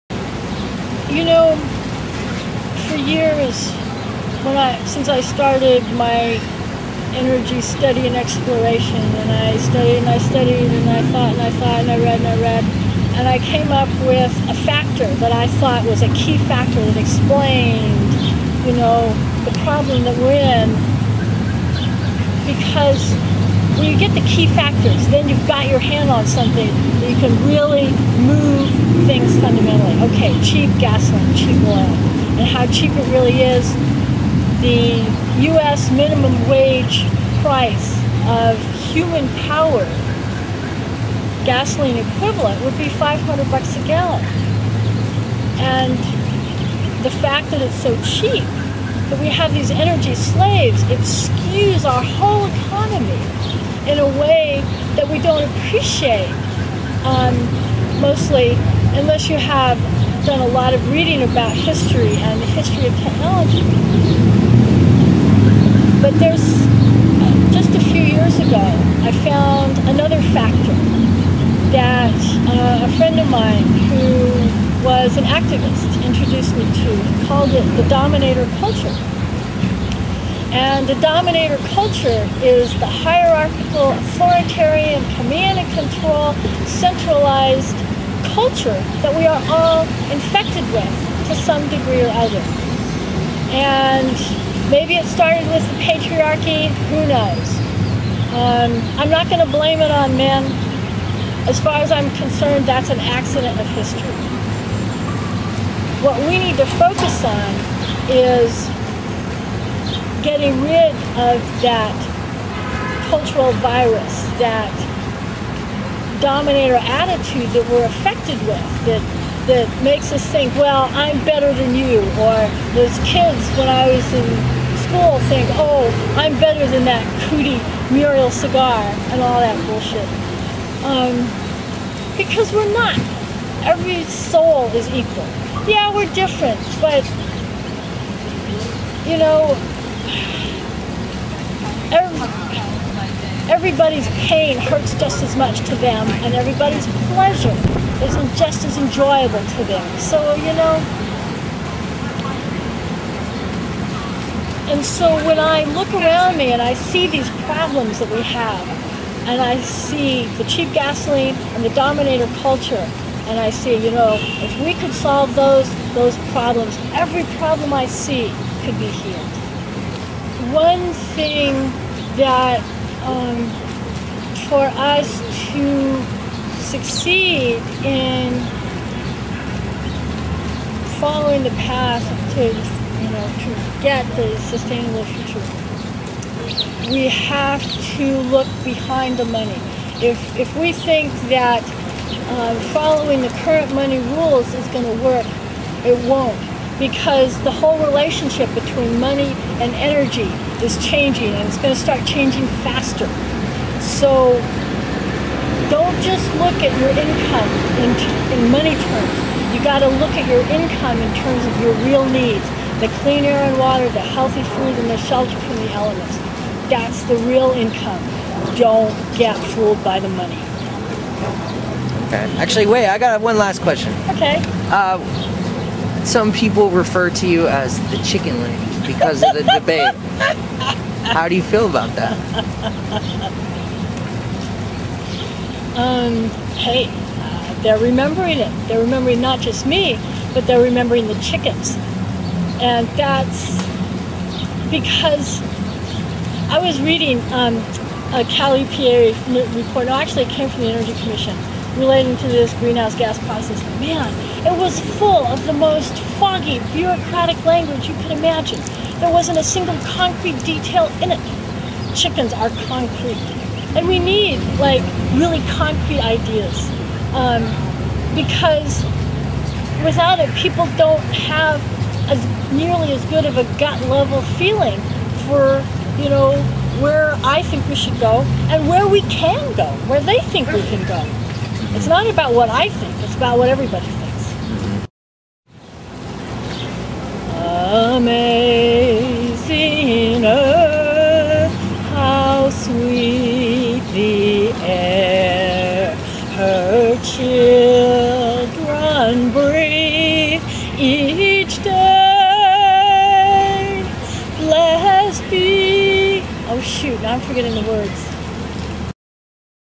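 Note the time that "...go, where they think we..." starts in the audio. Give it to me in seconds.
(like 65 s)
279 s.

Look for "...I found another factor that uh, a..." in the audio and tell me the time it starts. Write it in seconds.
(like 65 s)
69 s.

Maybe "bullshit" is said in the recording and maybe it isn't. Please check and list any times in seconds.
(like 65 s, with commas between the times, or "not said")
129 s.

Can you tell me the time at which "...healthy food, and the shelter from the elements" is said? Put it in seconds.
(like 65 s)
213 s.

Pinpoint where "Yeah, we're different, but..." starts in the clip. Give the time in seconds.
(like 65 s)
135 s.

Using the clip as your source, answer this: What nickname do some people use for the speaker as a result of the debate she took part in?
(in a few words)
the chicken lady.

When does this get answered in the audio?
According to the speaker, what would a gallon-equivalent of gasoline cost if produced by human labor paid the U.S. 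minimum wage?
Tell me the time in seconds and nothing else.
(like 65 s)
42 s.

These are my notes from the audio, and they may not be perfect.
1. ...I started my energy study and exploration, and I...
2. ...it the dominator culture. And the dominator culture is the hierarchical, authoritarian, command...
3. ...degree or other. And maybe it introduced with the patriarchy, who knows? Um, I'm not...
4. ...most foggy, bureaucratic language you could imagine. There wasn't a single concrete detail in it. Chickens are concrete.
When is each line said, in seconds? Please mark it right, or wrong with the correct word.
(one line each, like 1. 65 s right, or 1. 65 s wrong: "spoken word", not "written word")
1. 5 s right
2. 77 s right
3. 91 s wrong: "started", not "introduced"
4. 255 s right.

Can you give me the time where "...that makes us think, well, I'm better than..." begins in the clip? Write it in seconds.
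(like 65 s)
119 s.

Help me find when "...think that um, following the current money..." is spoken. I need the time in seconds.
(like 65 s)
190 s.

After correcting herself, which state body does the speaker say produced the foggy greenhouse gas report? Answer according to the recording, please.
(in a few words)
Energy Commission.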